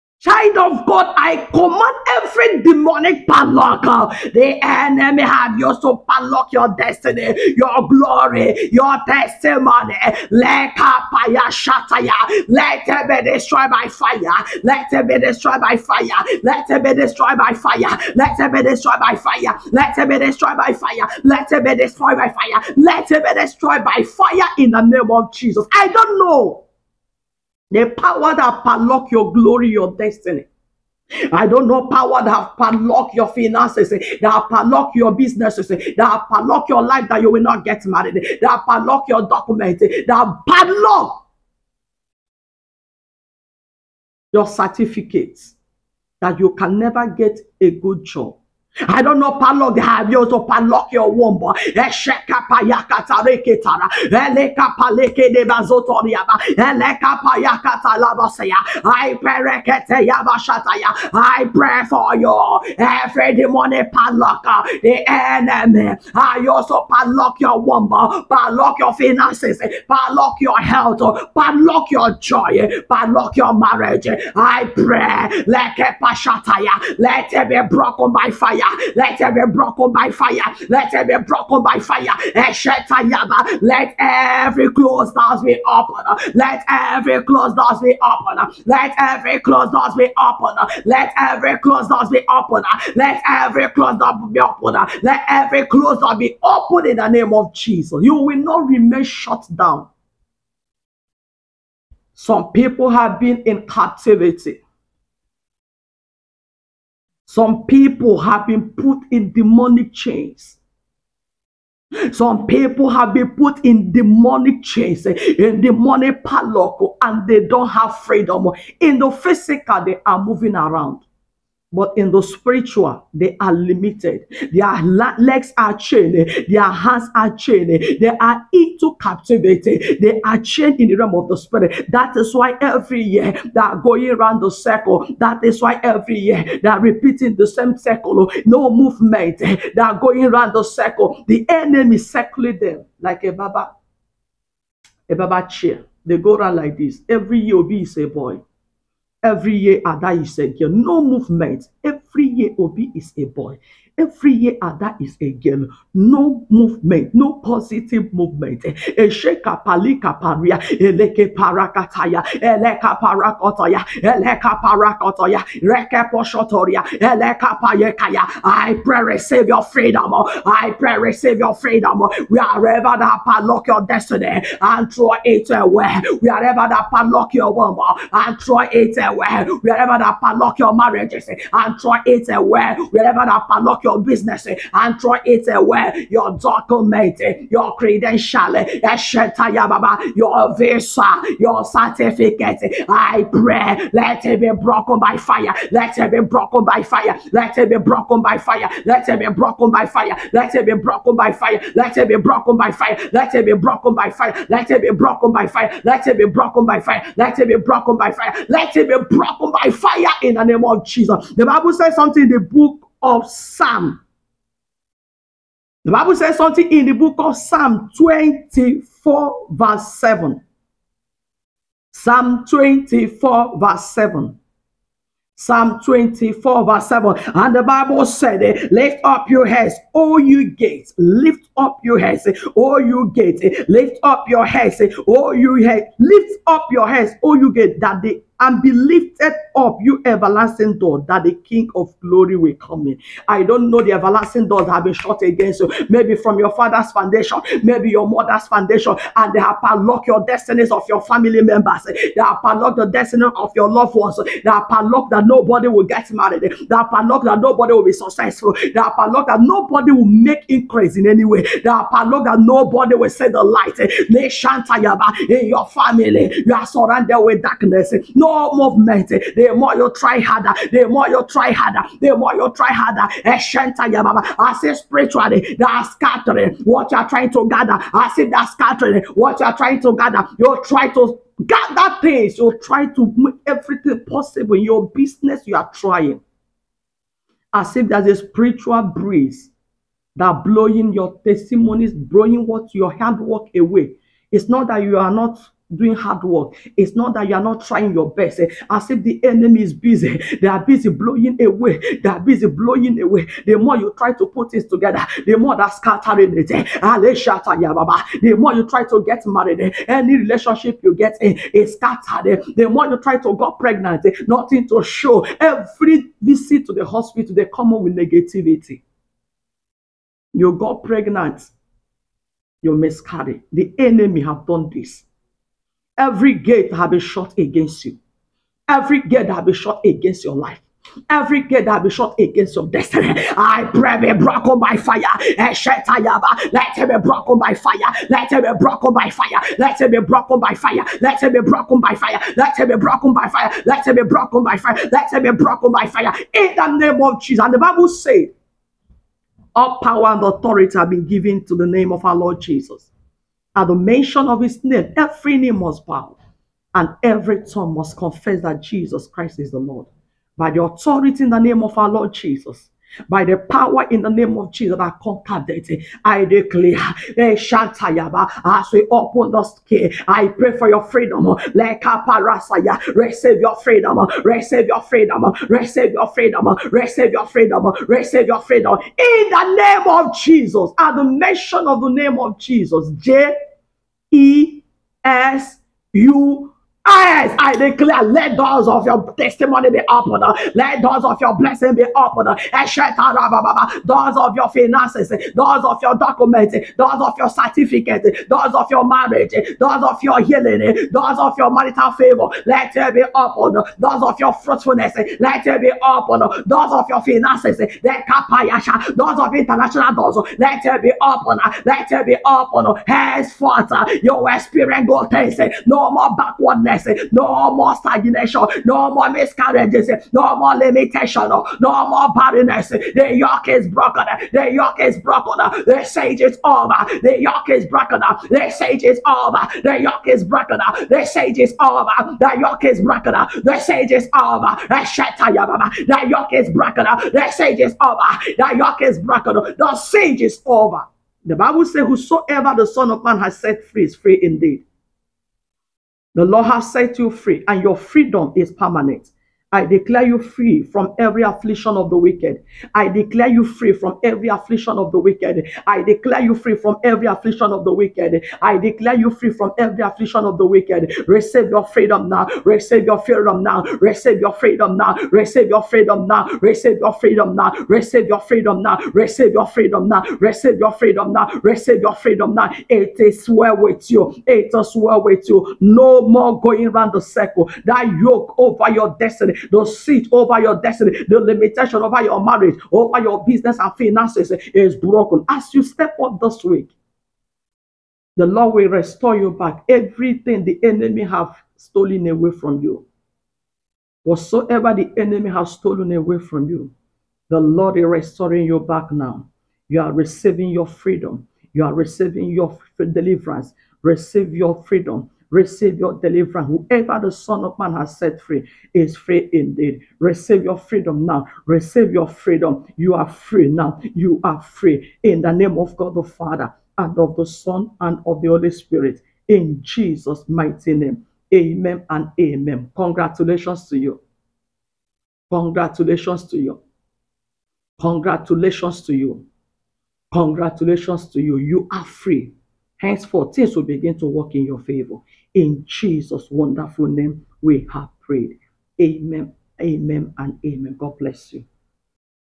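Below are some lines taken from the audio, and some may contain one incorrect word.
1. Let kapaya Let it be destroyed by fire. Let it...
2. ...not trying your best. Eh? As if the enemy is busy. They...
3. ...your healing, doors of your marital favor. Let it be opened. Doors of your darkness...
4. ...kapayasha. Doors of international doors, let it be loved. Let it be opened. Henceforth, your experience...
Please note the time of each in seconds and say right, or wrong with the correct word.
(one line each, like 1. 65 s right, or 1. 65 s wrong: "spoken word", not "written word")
1. 10 s right
2. 297 s right
3. 400 s wrong: "fruitfulness", not "darkness"
4. 408 s wrong: "opened", not "loved".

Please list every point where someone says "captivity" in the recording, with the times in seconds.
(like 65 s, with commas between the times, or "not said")
103 s, 128 s.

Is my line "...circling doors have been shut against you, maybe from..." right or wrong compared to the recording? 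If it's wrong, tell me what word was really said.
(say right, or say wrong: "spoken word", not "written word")
wrong: "everlasting", not "circling".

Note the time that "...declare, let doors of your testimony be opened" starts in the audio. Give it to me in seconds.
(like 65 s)
387 s.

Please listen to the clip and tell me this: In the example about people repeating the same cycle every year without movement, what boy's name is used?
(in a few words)
Obi.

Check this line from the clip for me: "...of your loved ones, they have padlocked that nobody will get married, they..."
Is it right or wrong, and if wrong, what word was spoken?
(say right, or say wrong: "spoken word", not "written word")
right.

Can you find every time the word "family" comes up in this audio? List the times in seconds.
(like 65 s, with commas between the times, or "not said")
251 s, 265 s.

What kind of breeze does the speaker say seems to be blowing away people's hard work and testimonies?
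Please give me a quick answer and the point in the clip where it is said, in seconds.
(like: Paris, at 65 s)
spiritual breeze, at 288 s.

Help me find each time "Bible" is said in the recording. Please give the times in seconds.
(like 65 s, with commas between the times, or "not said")
211 s, 215 s, 227 s, 347 s, 441 s.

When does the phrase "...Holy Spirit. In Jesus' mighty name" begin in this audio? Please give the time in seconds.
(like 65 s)
518 s.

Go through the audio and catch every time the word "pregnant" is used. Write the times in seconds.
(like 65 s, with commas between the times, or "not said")
313 s, 320 s.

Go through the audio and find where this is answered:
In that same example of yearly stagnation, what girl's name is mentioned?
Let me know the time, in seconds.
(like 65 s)
154 s.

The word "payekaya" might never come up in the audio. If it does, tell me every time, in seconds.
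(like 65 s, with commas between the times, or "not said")
167 s.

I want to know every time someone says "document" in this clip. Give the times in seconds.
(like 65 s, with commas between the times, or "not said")
39 s, 186 s, 395 s.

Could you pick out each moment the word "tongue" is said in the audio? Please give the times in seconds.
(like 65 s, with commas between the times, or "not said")
357 s.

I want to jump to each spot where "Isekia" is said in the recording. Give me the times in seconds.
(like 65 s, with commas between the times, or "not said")
150 s.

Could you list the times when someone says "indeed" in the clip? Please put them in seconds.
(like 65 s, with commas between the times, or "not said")
444 s, 509 s.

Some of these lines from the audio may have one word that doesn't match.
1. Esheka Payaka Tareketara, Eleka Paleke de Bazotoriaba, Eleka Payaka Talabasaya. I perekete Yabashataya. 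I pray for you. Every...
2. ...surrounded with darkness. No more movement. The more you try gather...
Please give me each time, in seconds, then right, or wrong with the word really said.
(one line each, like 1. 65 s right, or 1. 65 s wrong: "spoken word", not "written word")
1. 51 s right
2. 266 s wrong: "harder", not "gather".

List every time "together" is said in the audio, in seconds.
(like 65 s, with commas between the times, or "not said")
304 s.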